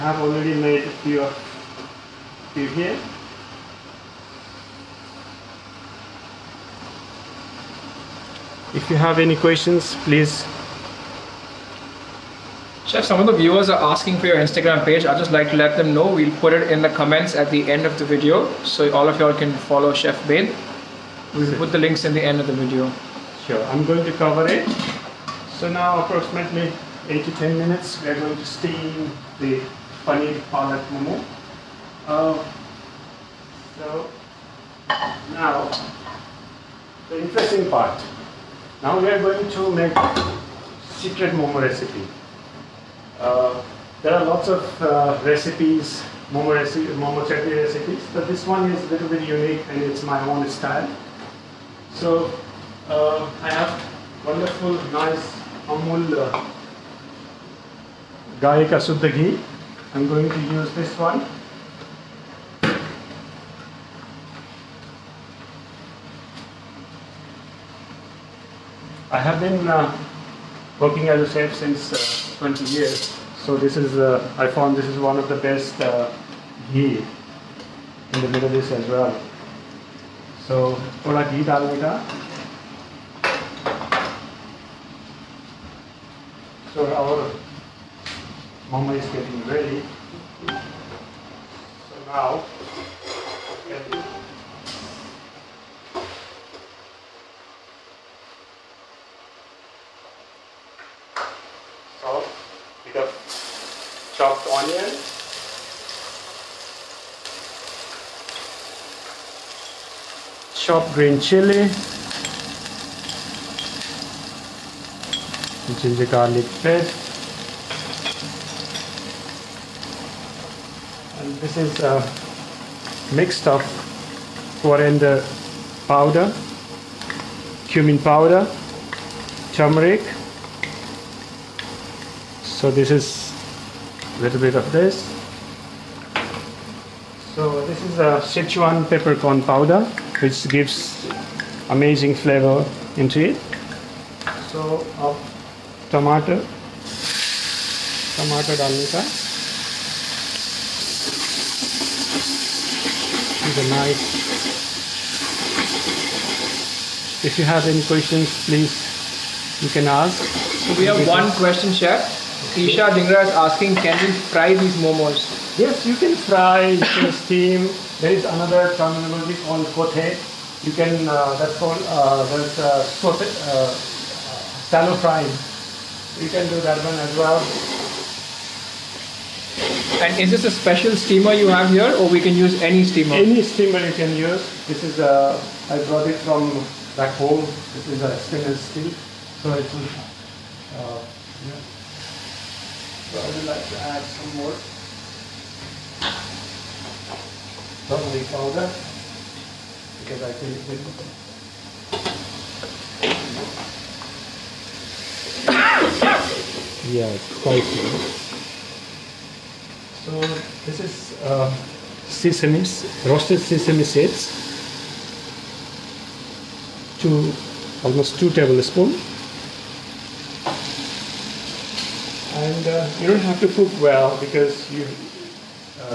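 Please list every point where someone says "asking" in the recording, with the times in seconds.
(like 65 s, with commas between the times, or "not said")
13 s, 163 s.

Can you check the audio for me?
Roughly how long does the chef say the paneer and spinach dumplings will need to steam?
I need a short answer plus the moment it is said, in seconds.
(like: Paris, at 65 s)
8 to 10 minutes, at 27 s.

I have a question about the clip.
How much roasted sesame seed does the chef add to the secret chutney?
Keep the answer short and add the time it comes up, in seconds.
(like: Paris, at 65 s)
2 tablespoons, at 218 s.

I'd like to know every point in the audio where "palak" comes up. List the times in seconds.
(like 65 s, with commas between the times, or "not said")
30 s.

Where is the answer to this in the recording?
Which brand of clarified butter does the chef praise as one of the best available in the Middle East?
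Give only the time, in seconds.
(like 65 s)
55 s.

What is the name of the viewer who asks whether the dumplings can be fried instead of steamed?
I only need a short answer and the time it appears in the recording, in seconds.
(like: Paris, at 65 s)
Isha Dingra, at 162 s.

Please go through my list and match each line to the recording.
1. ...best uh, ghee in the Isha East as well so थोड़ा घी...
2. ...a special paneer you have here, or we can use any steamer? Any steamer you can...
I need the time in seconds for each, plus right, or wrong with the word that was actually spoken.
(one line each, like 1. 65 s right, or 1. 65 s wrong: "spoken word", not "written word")
1. 75 s wrong: "Middle", not "Isha"
2. 180 s wrong: "steamer", not "paneer".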